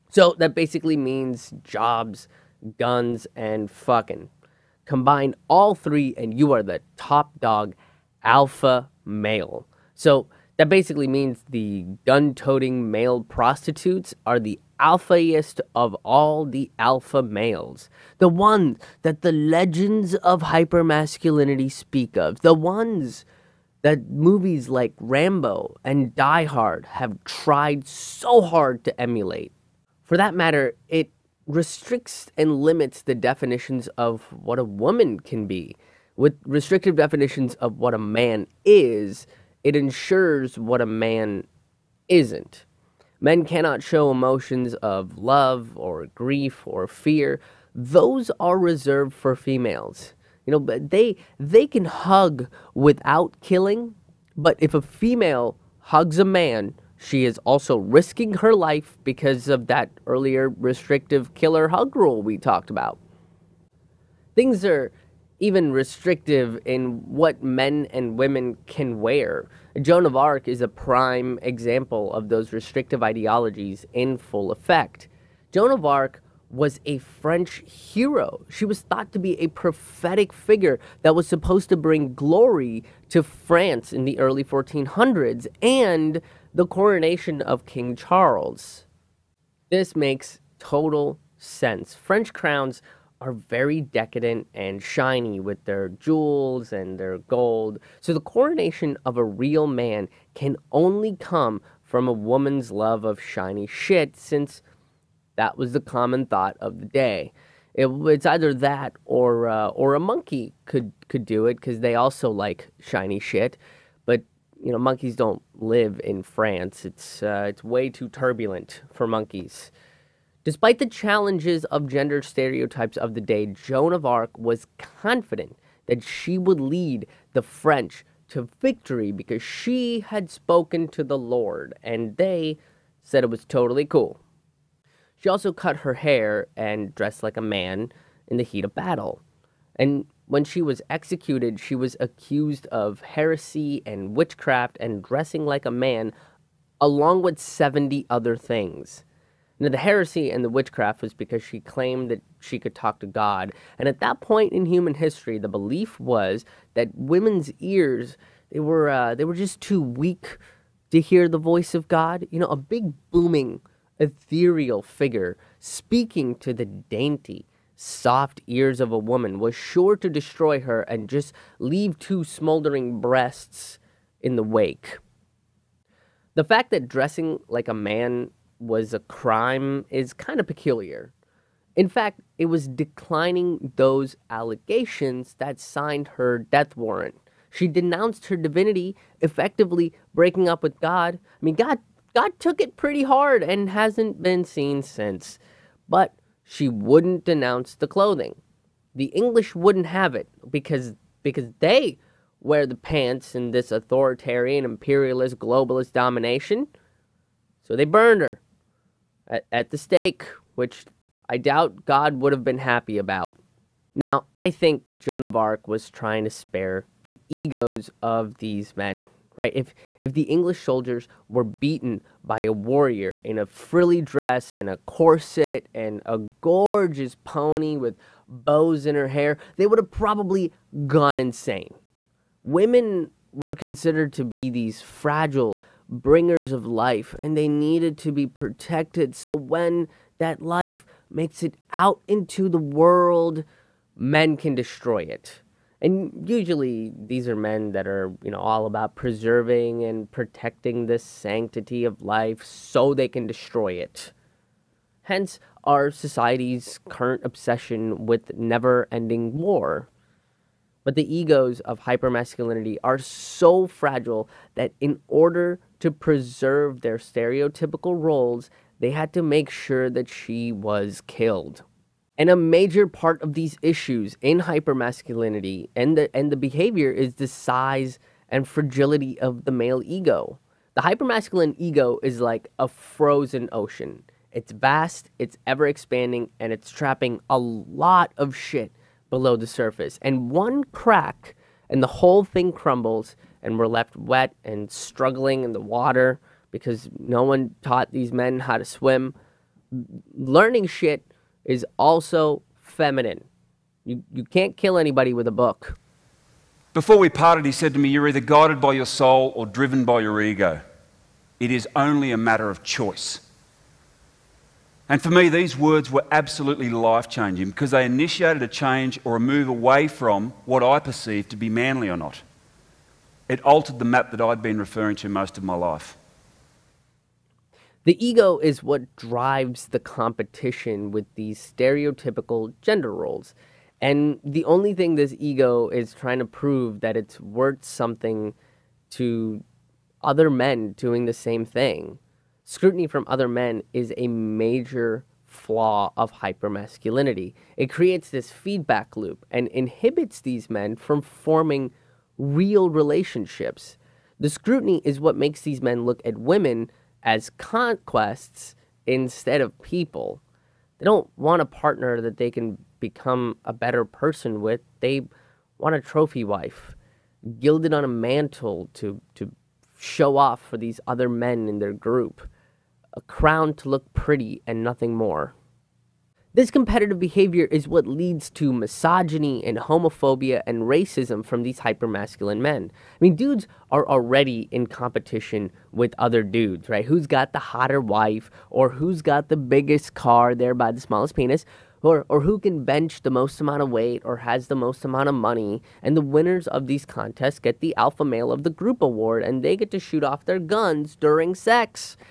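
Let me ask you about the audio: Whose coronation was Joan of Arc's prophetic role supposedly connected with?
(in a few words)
King Charles.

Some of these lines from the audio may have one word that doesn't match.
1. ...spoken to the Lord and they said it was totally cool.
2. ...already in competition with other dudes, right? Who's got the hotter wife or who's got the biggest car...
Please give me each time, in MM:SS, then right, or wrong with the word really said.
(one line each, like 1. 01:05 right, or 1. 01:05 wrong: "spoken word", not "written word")
1. 02:10 right
2. 06:23 right.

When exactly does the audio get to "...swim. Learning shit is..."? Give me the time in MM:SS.
04:58.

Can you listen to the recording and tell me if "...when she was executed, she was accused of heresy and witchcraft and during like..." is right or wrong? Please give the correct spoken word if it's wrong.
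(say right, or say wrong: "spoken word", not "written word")
wrong: "dressing", not "during".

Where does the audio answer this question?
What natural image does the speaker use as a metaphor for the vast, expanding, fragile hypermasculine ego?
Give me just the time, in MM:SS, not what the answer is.
04:42.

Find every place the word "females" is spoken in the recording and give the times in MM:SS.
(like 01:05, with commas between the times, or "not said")
00:49, 00:54.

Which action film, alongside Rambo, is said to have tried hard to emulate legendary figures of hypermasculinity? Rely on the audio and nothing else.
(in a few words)
Die Hard.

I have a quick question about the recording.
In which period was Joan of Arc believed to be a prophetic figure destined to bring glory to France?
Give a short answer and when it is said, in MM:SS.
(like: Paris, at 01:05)
early 1400s, at 01:24.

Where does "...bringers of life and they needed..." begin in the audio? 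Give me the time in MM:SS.
03:55.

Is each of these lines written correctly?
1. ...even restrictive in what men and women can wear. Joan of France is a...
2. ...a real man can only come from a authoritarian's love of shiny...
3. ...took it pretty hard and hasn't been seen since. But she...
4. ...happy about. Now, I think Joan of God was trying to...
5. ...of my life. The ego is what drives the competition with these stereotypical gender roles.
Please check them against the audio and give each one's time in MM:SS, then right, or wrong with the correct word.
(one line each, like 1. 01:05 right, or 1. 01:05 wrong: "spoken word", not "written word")
1. 01:05 wrong: "Arc", not "France"
2. 01:39 wrong: "woman", not "authoritarian"
3. 03:12 right
4. 03:32 wrong: "Arc", not "God"
5. 05:25 right.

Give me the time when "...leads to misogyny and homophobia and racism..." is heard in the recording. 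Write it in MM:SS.
06:17.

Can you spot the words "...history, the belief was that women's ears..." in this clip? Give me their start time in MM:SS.
02:34.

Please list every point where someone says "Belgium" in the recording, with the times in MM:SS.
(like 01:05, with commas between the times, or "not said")
not said.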